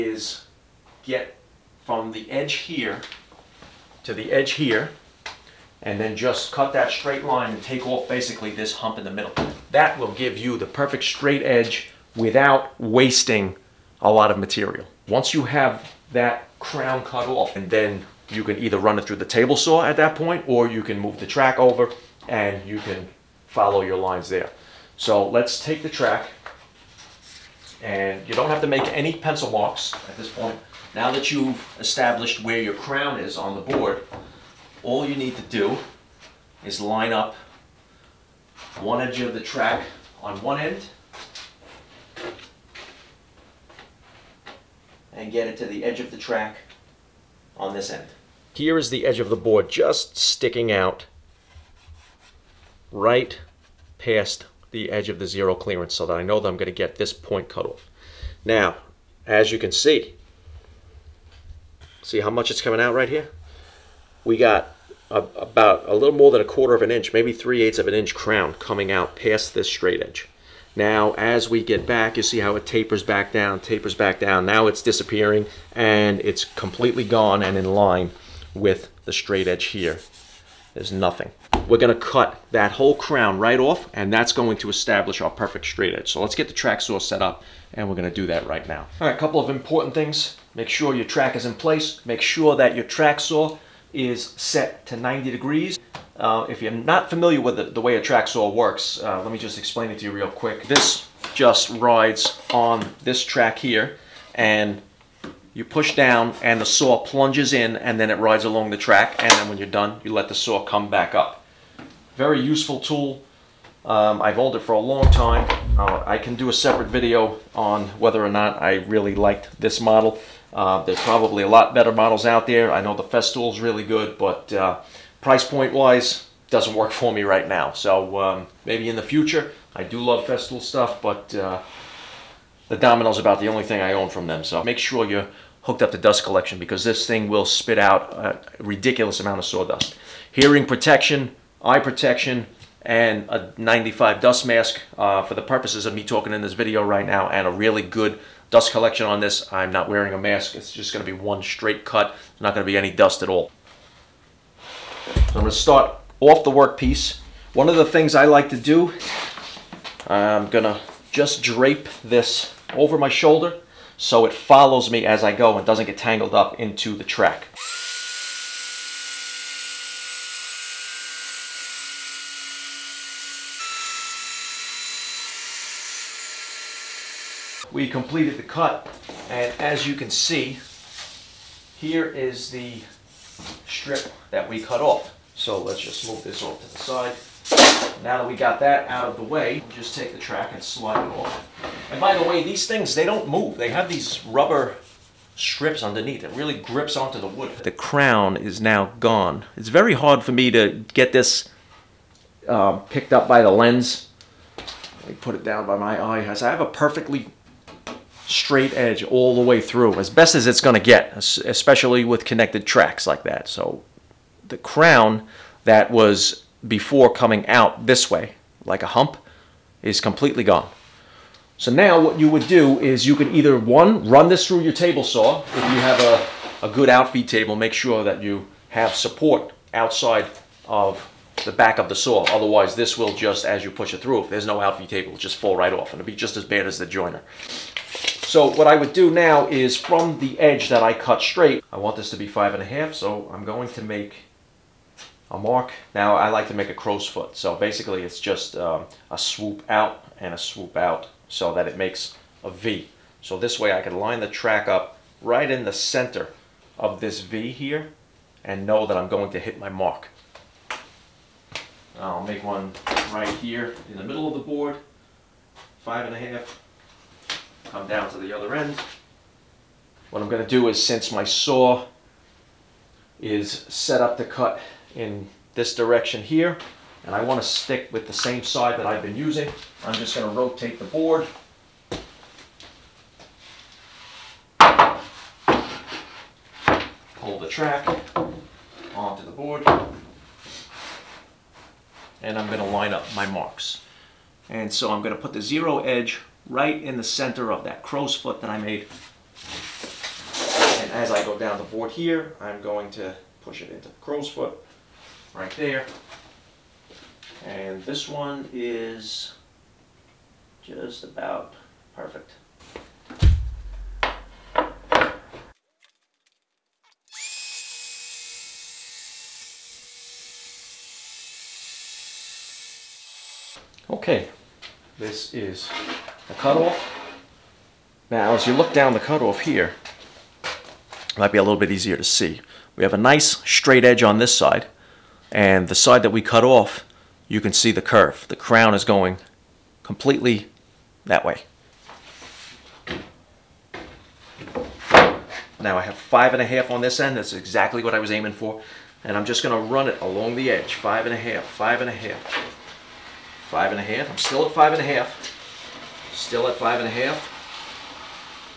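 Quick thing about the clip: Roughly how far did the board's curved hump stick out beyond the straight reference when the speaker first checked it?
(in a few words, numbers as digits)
3/8 of an inch.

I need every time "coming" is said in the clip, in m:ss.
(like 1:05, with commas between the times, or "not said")
1:02, 1:08, 3:37.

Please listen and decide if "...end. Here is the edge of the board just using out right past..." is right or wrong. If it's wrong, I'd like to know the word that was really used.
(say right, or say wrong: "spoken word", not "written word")
wrong: "sticking", not "using".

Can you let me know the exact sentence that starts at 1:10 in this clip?
Now, as we get back, you see how it tapers back down, tapers back down.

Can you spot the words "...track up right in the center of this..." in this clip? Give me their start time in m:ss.
4:14.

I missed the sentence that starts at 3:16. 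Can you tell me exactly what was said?
It really grips onto the wood.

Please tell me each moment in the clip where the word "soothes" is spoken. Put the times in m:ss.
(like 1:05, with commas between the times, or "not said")
not said.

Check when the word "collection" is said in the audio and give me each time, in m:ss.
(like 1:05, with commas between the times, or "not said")
2:16, 2:28.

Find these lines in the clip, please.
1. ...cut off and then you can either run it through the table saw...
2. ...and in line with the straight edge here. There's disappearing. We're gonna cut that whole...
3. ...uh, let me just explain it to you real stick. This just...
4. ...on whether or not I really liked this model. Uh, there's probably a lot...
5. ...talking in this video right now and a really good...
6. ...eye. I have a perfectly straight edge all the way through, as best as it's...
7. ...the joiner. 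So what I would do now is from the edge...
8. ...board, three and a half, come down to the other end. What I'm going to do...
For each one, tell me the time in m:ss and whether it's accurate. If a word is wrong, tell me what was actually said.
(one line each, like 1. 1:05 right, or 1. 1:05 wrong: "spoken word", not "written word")
1. 0:17 right
2. 1:17 wrong: "nothing", not "disappearing"
3. 1:39 wrong: "quick", not "stick"
4. 1:57 right
5. 2:26 right
6. 3:25 right
7. 3:56 right
8. 4:24 wrong: "five", not "three".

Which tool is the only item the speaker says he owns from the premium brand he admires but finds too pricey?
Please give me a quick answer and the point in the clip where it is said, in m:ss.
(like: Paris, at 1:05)
Domino, at 2:12.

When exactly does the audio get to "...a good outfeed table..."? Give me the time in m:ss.
3:46.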